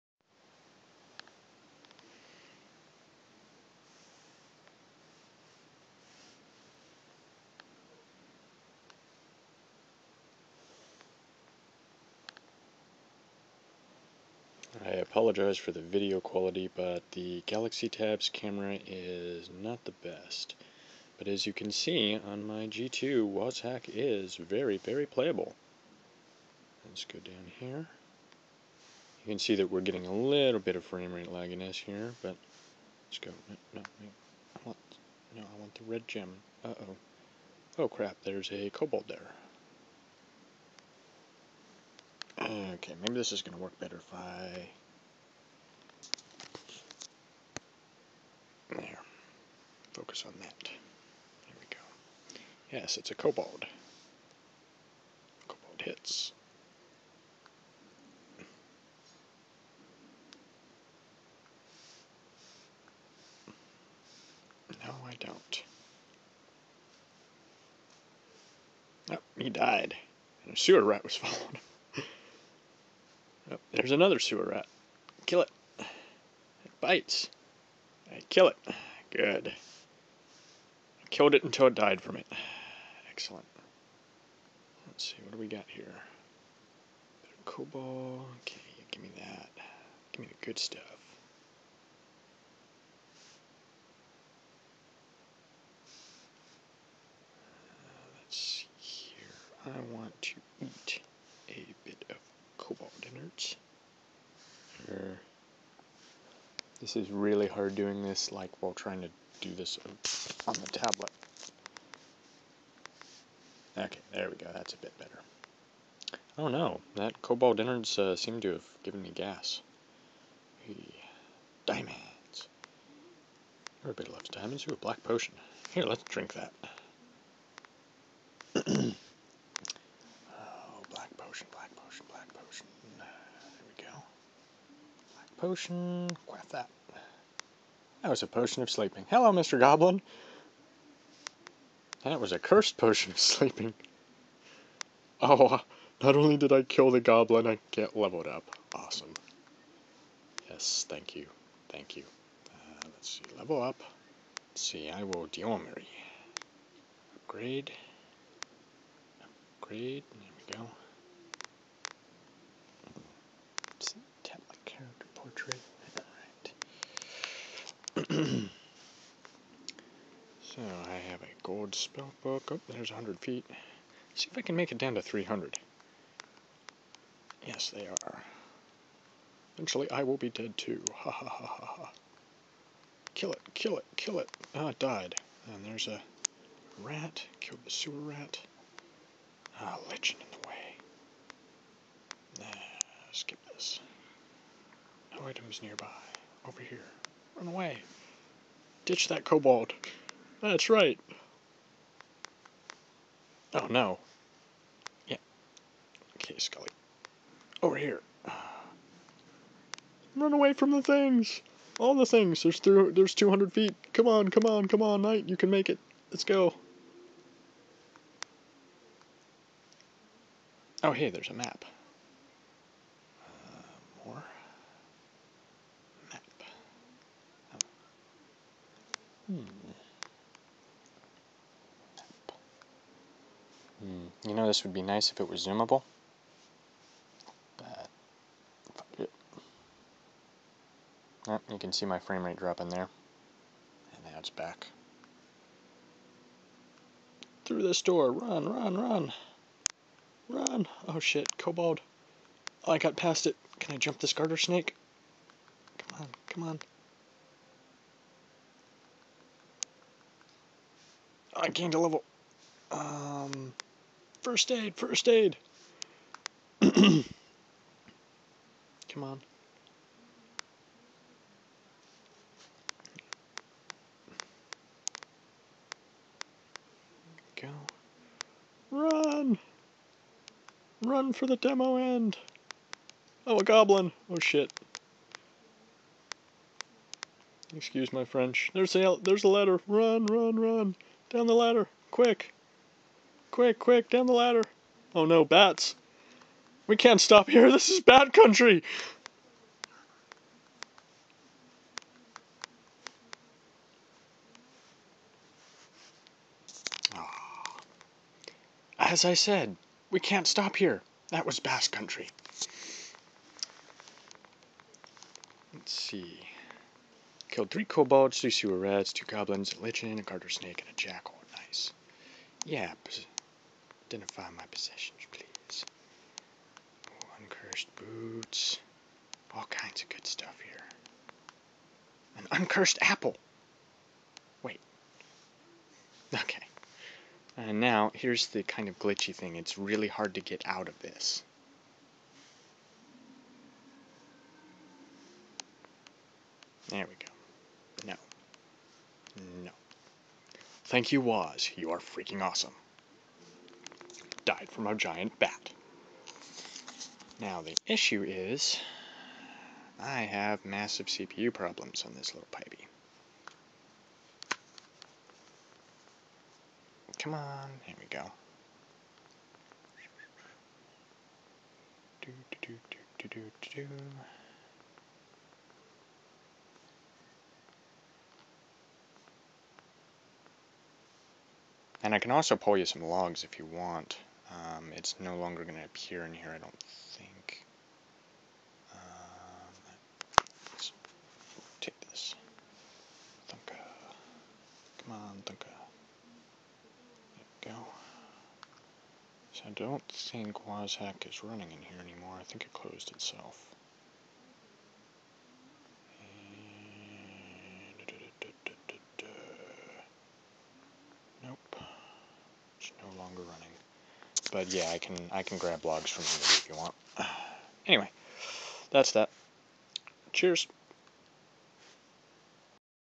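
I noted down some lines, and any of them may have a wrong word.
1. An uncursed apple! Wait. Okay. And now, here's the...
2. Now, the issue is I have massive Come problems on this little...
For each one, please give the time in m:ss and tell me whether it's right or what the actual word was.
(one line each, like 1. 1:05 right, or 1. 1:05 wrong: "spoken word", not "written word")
1. 5:32 right
2. 5:57 wrong: "CPU", not "Come".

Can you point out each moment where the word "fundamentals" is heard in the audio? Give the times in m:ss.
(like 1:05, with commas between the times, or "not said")
not said.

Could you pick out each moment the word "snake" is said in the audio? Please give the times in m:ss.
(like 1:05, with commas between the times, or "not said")
4:14, 5:20.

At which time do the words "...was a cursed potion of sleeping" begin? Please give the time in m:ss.
2:22.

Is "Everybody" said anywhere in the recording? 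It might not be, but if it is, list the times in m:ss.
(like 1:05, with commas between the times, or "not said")
2:03.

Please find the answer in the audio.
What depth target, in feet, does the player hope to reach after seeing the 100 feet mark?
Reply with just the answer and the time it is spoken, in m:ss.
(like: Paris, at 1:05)
300, at 2:55.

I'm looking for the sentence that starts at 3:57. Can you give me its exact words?
But, oh, you can see my frame rate dropping there.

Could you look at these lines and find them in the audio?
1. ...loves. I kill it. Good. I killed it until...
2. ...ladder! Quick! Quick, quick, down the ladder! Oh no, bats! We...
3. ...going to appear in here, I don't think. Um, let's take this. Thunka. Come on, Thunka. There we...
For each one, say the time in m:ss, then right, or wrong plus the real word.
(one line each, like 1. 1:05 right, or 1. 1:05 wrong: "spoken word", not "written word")
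1. 1:16 wrong: "bites", not "loves"
2. 4:51 right
3. 6:25 right.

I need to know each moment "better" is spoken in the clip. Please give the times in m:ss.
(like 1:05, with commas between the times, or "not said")
0:43, 1:54.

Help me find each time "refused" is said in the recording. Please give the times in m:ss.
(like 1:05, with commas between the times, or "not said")
not said.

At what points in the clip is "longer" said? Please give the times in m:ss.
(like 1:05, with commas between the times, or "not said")
6:25, 6:53.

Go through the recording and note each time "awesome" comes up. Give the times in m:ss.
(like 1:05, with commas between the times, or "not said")
2:28, 5:52.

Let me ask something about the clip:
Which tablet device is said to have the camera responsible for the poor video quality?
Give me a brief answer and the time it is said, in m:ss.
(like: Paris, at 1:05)
Galaxy Tab, at 0:17.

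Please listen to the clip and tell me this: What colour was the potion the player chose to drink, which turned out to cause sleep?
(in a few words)
black.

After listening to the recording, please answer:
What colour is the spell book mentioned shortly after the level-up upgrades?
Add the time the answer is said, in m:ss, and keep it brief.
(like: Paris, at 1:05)
gold, at 2:51.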